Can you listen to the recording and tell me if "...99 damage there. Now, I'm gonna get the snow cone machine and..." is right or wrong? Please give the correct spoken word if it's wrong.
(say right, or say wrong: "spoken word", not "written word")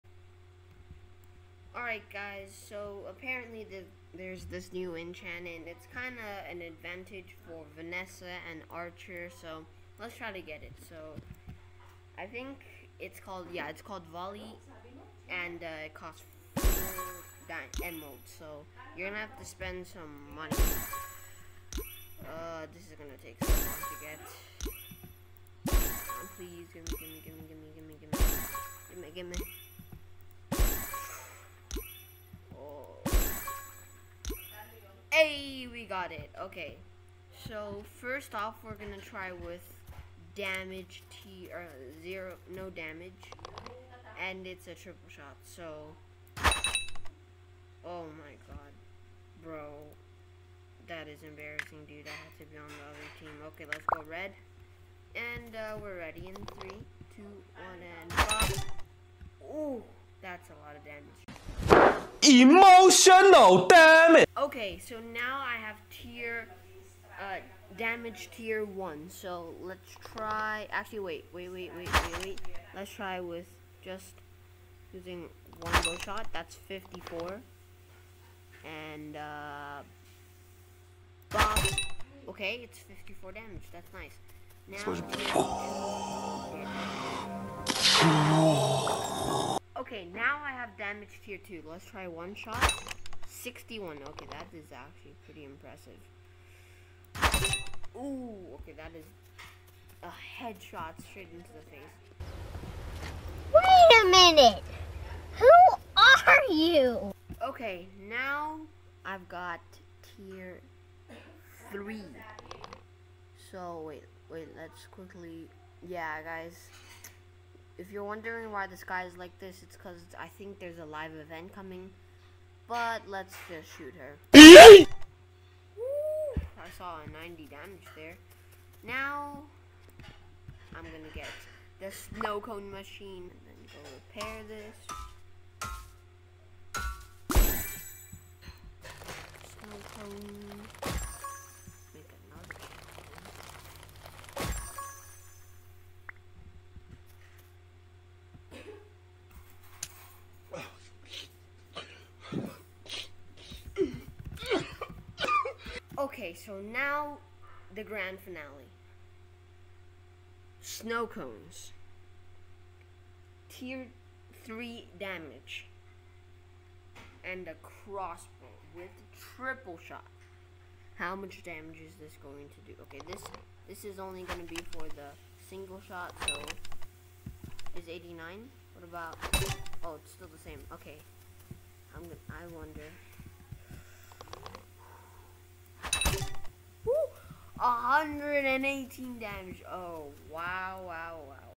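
wrong: "90", not "99".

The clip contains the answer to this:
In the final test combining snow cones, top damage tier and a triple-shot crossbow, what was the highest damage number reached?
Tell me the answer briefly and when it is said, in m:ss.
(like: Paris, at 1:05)
118, at 3:07.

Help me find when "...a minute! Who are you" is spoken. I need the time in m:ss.
1:44.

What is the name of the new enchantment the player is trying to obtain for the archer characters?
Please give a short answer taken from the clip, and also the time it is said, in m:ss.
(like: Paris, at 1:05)
Volley, at 0:14.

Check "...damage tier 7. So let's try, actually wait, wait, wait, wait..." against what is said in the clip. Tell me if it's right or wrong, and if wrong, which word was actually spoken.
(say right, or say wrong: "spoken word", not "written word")
wrong: "1", not "7".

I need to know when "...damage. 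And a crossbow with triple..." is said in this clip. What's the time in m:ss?
2:44.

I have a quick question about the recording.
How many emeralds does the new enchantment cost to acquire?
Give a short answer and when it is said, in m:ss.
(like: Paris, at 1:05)
4, at 0:16.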